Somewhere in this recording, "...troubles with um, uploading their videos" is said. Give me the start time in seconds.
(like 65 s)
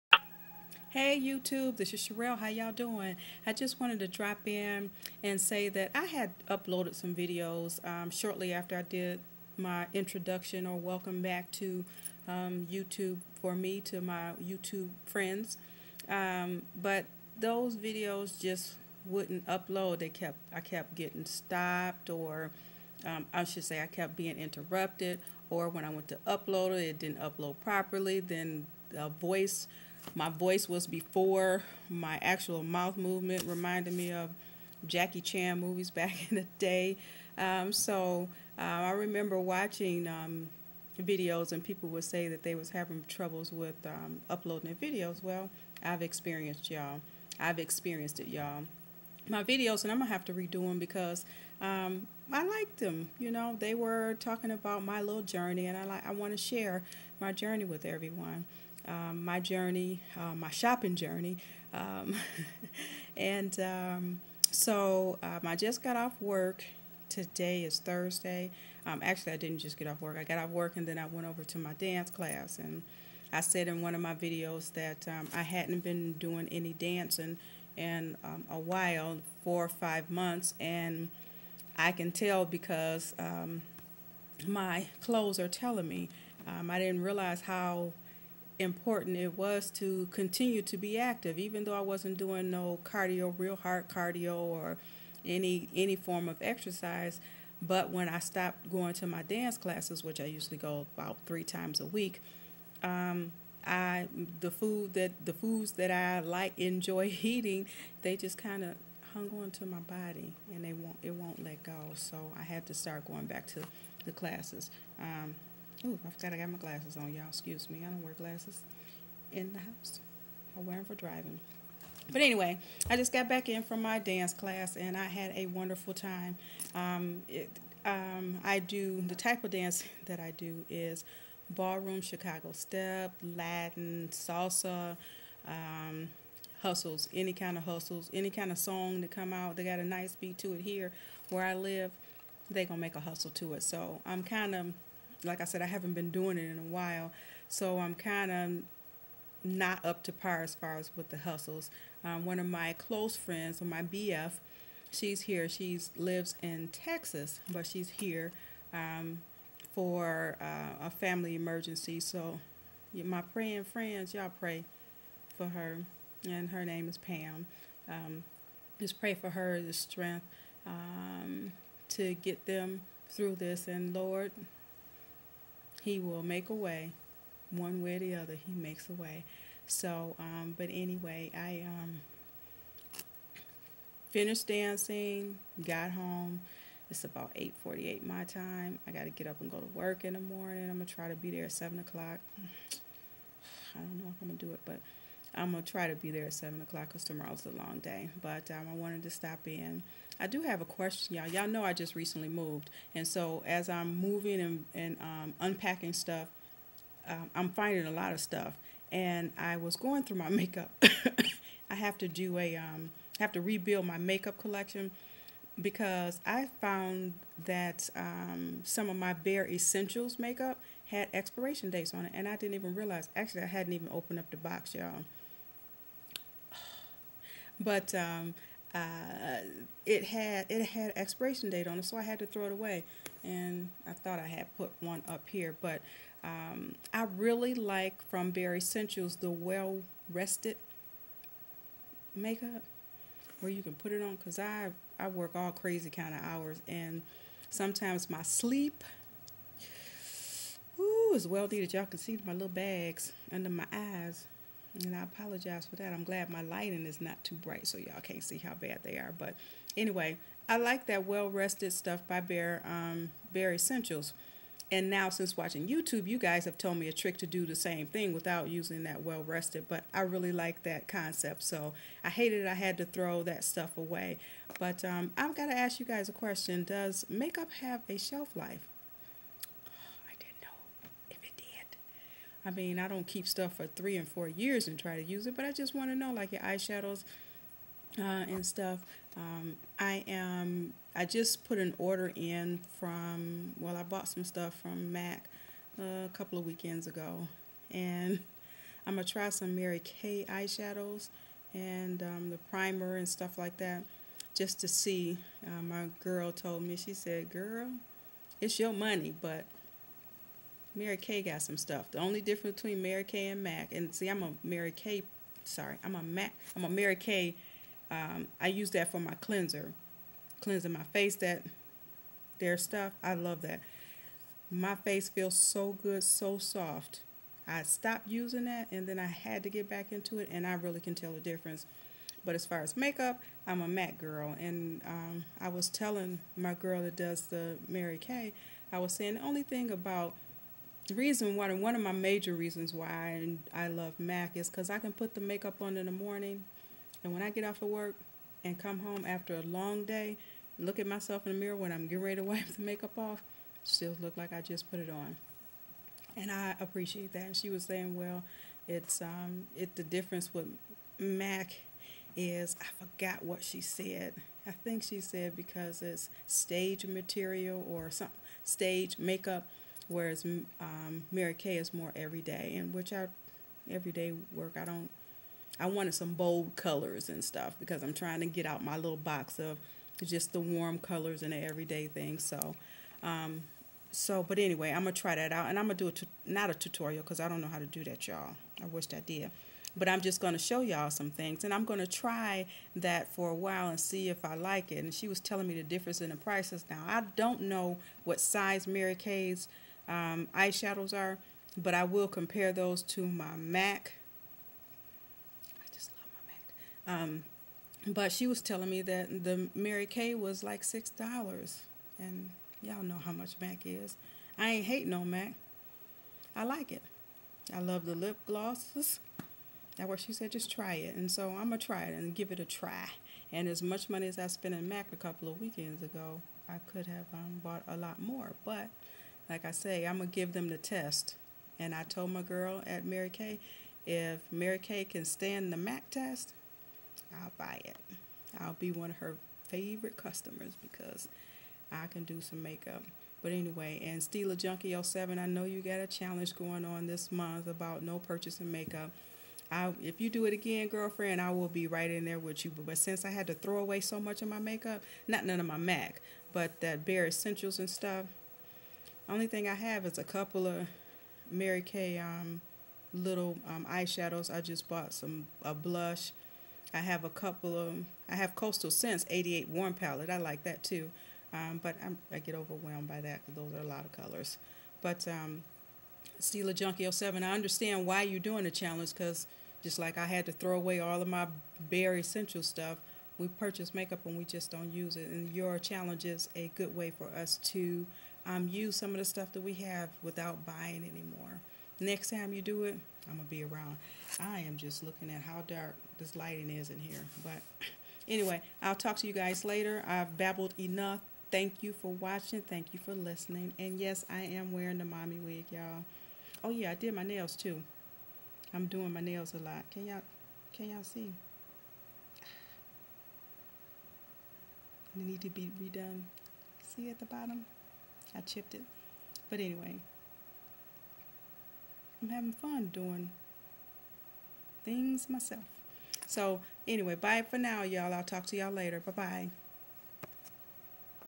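43 s.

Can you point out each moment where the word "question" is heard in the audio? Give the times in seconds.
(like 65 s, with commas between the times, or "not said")
200 s, 276 s.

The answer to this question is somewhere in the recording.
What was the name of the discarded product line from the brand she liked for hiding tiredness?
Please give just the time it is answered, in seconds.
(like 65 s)
239 s.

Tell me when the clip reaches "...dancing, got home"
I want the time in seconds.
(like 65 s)
184 s.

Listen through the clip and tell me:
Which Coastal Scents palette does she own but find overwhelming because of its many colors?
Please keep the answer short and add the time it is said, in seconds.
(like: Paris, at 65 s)
88 Warm Palette, at 469 s.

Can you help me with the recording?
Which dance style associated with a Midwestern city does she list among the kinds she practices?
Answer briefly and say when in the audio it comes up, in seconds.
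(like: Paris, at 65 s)
Chicago step, at 132 s.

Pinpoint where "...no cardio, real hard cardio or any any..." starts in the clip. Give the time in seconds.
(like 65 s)
92 s.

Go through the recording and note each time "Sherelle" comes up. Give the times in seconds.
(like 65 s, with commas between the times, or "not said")
2 s.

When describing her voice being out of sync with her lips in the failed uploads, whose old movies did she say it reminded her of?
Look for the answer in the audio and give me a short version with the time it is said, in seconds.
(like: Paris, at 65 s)
Jackie Chan, at 34 s.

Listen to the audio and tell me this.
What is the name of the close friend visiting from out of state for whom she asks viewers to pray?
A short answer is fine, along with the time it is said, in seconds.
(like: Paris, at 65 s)
Pam, at 166 s.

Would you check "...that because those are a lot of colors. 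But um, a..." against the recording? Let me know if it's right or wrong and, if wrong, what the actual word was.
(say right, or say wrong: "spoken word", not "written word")
right.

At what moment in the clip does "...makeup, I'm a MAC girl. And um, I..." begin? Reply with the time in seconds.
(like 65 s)
332 s.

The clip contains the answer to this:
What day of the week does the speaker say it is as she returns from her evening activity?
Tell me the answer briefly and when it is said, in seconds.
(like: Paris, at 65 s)
Thursday, at 67 s.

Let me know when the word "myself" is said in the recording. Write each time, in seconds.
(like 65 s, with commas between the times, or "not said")
350 s, 525 s.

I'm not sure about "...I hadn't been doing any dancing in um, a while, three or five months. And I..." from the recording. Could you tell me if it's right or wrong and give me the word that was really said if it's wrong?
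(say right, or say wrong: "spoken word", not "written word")
wrong: "four", not "three".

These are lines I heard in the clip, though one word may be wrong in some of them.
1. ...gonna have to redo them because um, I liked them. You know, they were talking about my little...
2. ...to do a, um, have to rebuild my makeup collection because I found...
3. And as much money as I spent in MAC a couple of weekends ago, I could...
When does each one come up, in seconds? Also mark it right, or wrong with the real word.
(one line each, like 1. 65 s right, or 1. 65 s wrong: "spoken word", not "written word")
1. 49 s right
2. 211 s right
3. 423 s right.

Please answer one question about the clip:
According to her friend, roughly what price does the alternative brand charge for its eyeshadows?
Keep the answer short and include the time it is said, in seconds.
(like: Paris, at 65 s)
$6, at 410 s.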